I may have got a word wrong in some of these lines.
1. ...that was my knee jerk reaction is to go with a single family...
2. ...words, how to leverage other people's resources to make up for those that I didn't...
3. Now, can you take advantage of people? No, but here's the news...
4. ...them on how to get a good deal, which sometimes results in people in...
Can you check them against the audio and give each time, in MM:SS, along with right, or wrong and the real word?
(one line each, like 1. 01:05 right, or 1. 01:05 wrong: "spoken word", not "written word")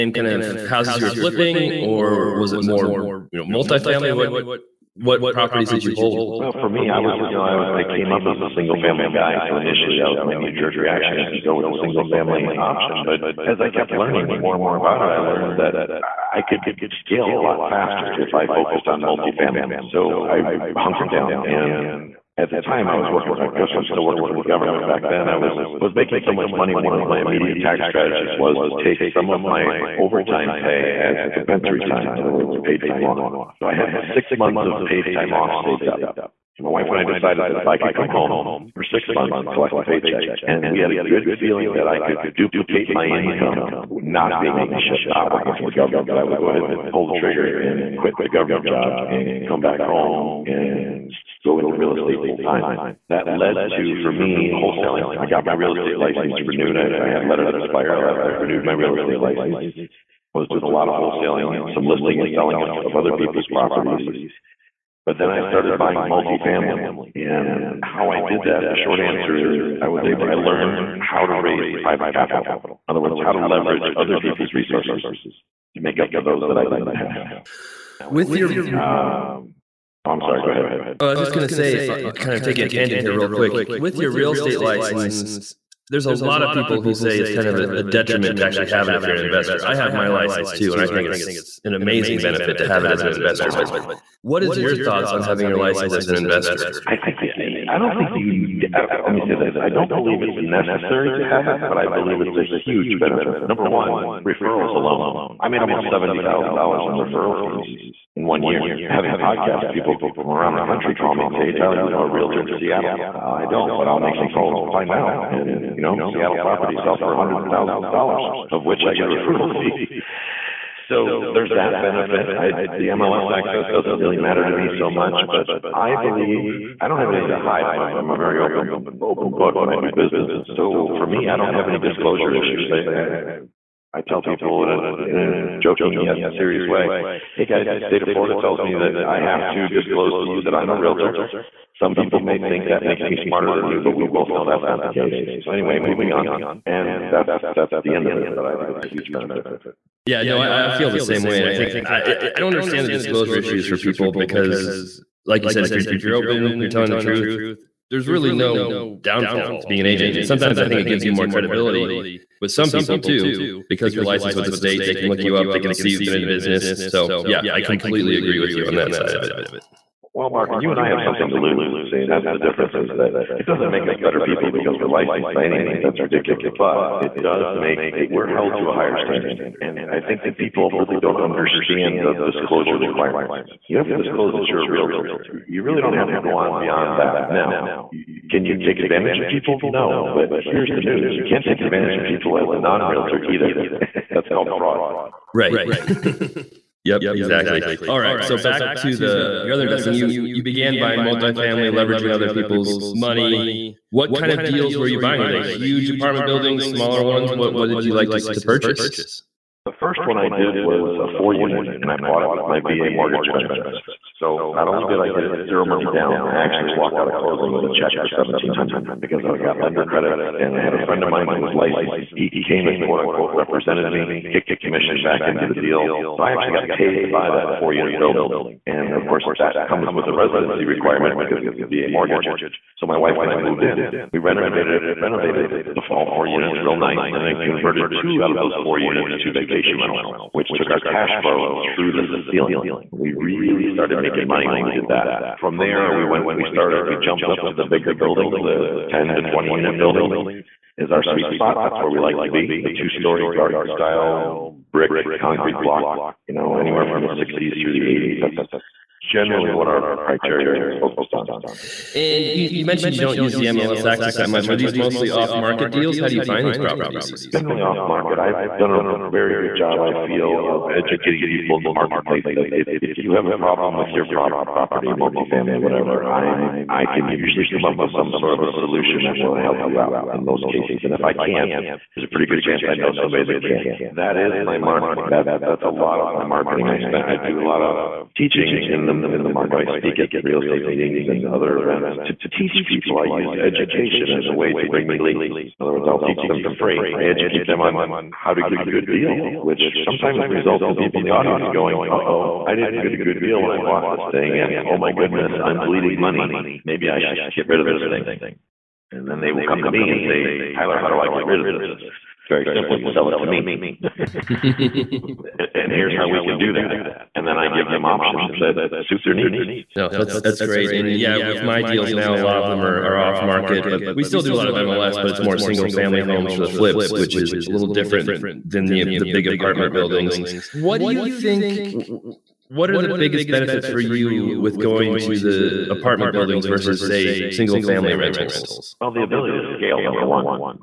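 1. 00:09 right
2. 01:12 right
3. 03:07 right
4. 04:57 right.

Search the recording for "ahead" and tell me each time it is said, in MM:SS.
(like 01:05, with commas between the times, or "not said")
00:46, 01:20.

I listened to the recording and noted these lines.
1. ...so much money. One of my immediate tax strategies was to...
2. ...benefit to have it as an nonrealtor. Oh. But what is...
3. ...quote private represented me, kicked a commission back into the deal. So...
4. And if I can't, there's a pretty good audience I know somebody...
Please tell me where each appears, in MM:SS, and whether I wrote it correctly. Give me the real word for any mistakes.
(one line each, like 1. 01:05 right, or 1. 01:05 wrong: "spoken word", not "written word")
1. 00:26 right
2. 01:32 wrong: "investor", not "nonrealtor"
3. 03:42 wrong: "unquote", not "private"
4. 04:40 wrong: "chance", not "audience".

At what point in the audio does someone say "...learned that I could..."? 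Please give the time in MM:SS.
00:15.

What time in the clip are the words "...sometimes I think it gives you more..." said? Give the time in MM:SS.
02:40.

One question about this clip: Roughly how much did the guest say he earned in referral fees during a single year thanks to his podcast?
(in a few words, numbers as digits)
$70,000.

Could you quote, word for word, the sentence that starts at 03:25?
Were they huge apartment buildings, smaller ones?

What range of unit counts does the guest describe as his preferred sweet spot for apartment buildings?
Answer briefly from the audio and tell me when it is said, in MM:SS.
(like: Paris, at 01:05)
10 to 20 units, at 04:08.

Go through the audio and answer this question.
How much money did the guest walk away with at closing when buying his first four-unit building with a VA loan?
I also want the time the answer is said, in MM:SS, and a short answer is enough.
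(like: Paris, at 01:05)
$1,700, at 03:38.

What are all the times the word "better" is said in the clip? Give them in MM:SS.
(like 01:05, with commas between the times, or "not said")
02:54.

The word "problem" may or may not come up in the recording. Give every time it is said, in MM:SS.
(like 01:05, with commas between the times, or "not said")
04:33.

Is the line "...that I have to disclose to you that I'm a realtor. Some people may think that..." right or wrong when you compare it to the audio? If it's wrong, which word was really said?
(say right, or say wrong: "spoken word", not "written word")
right.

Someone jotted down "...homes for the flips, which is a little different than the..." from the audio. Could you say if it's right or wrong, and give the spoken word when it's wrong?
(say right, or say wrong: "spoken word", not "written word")
right.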